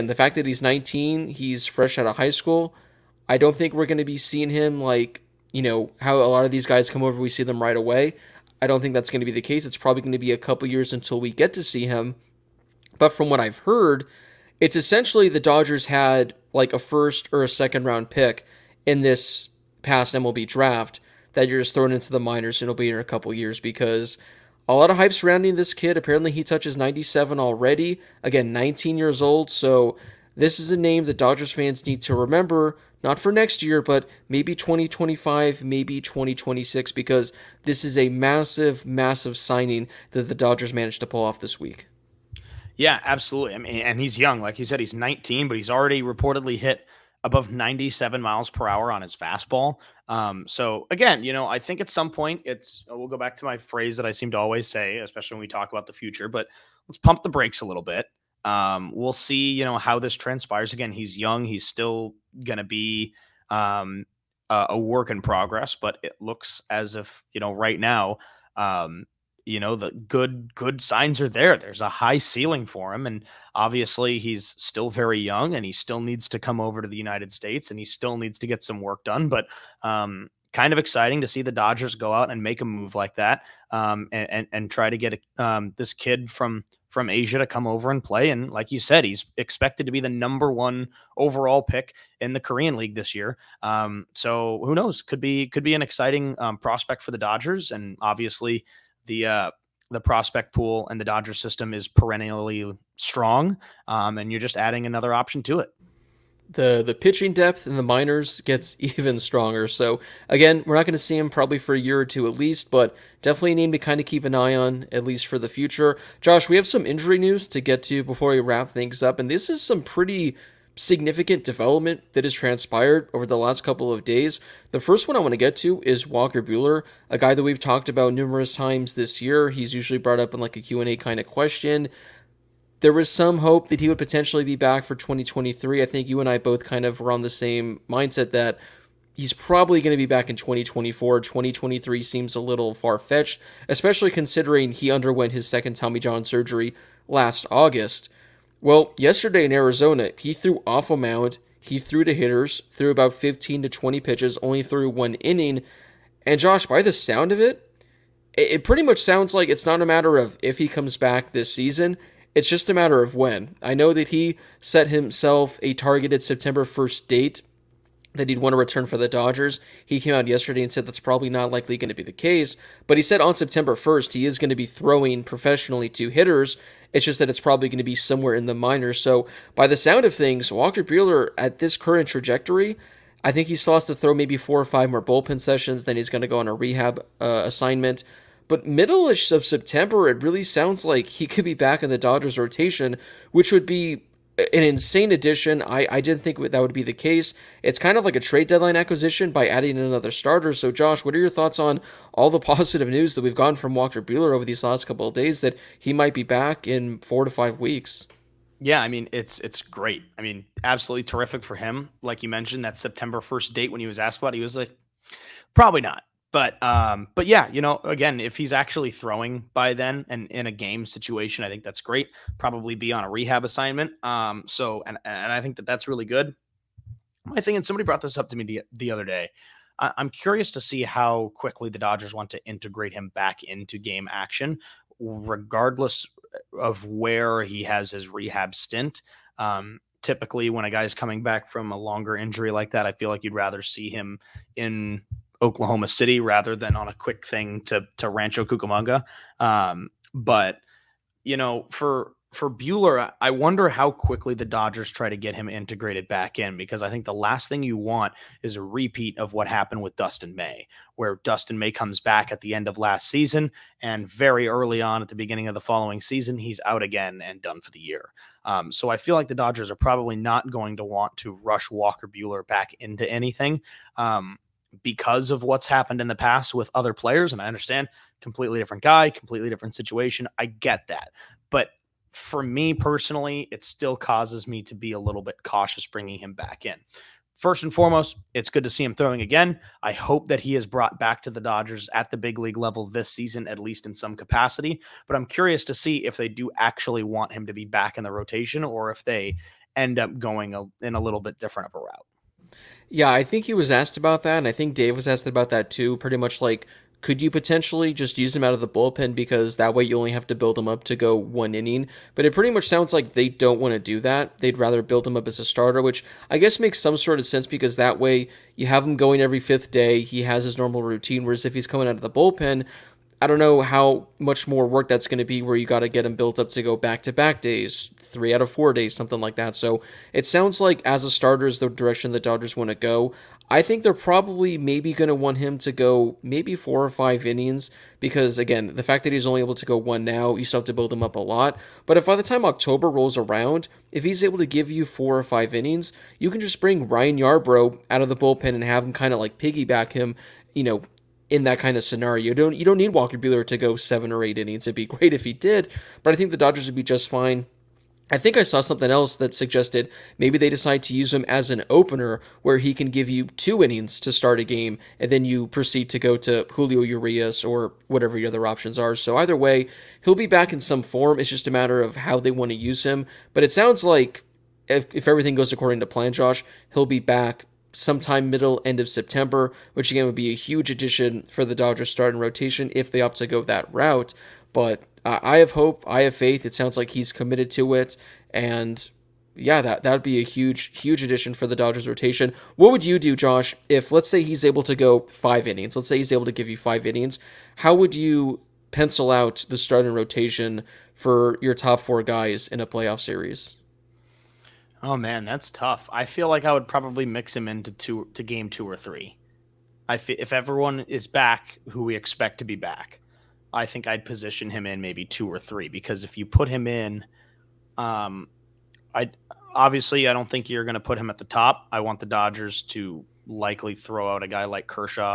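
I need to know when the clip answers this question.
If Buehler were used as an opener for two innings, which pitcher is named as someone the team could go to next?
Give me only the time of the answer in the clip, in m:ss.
6:06.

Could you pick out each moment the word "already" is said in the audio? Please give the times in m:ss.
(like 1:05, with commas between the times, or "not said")
0:27, 0:45.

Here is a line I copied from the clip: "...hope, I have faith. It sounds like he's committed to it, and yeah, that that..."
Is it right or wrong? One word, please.
right.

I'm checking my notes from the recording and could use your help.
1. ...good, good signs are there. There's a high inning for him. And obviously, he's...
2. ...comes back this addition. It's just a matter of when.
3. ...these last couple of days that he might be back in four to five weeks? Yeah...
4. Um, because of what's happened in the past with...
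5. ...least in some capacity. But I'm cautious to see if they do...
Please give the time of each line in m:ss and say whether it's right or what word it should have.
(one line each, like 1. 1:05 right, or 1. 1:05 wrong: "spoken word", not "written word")
1. 1:09 wrong: "ceiling", not "inning"
2. 2:40 wrong: "season", not "addition"
3. 3:24 right
4. 4:33 right
5. 4:53 wrong: "curious", not "cautious".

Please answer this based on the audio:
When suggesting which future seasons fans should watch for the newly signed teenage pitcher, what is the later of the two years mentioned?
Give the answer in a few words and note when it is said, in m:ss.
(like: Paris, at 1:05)
2026, at 0:36.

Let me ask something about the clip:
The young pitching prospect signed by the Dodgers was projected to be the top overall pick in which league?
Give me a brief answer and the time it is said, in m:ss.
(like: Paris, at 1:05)
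Korean League, at 1:32.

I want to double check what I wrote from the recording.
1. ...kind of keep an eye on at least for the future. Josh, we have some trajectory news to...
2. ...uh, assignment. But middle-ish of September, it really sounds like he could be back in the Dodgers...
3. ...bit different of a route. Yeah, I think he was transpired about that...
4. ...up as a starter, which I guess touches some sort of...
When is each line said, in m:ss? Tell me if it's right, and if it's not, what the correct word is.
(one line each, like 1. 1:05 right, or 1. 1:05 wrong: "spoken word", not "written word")
1. 1:53 wrong: "injury", not "trajectory"
2. 3:07 right
3. 5:01 wrong: "asked", not "transpired"
4. 5:15 wrong: "makes", not "touches".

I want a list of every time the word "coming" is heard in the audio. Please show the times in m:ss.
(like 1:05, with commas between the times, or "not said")
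4:00, 5:21.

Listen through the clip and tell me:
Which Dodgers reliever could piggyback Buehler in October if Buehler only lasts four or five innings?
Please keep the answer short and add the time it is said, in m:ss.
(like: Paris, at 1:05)
Ryan Yarbrough, at 5:46.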